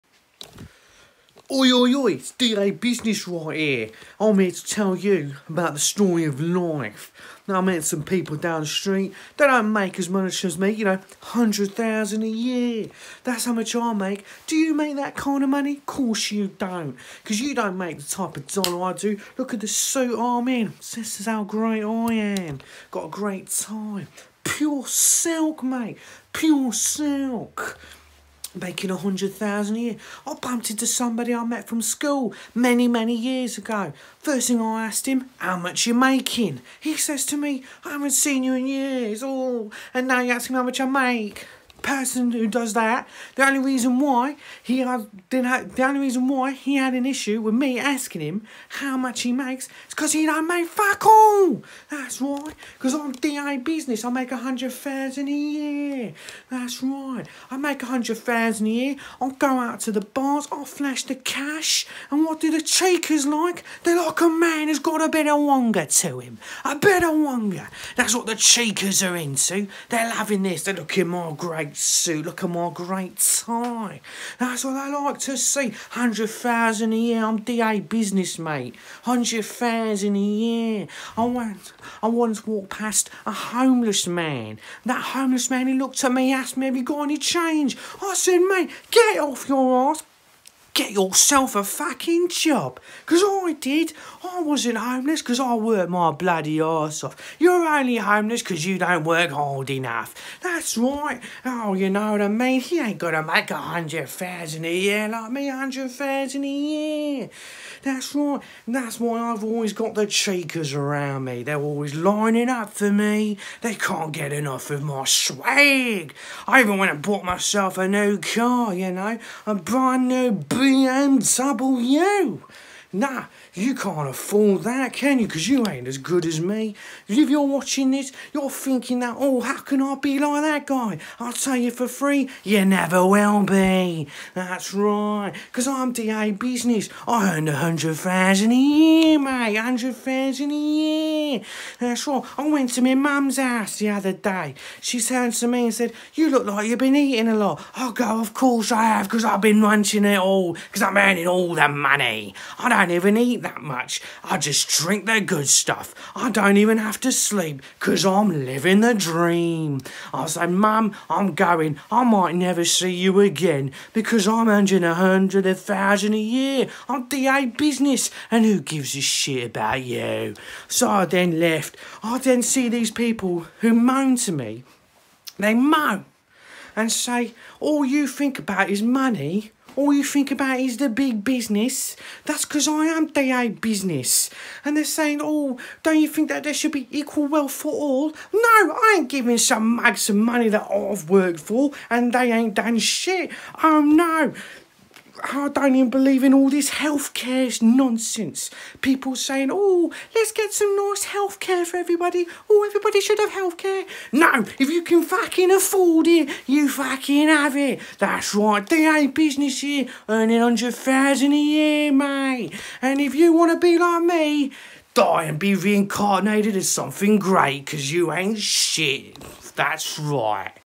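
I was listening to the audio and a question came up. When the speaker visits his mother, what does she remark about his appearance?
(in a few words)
Been eating a lot.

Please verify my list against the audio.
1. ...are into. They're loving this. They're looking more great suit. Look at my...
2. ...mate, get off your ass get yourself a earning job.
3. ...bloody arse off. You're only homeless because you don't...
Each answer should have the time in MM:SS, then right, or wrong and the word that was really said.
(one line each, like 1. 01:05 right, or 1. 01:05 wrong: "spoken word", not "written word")
1. 01:09 right
2. 01:28 wrong: "fucking", not "earning"
3. 01:36 right.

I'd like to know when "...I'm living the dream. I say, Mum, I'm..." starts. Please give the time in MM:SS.
02:38.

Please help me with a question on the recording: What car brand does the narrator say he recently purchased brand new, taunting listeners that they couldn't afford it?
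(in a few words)
BMW.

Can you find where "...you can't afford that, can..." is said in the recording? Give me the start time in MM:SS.
02:03.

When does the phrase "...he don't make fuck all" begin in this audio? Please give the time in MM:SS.
00:50.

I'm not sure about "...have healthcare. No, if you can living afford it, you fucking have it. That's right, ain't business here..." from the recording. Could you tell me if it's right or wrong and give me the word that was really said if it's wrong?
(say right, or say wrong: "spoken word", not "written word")
wrong: "fucking", not "living".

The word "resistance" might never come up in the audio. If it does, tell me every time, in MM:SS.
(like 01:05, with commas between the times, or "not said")
not said.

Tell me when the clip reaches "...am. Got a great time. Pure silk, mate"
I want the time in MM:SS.
00:22.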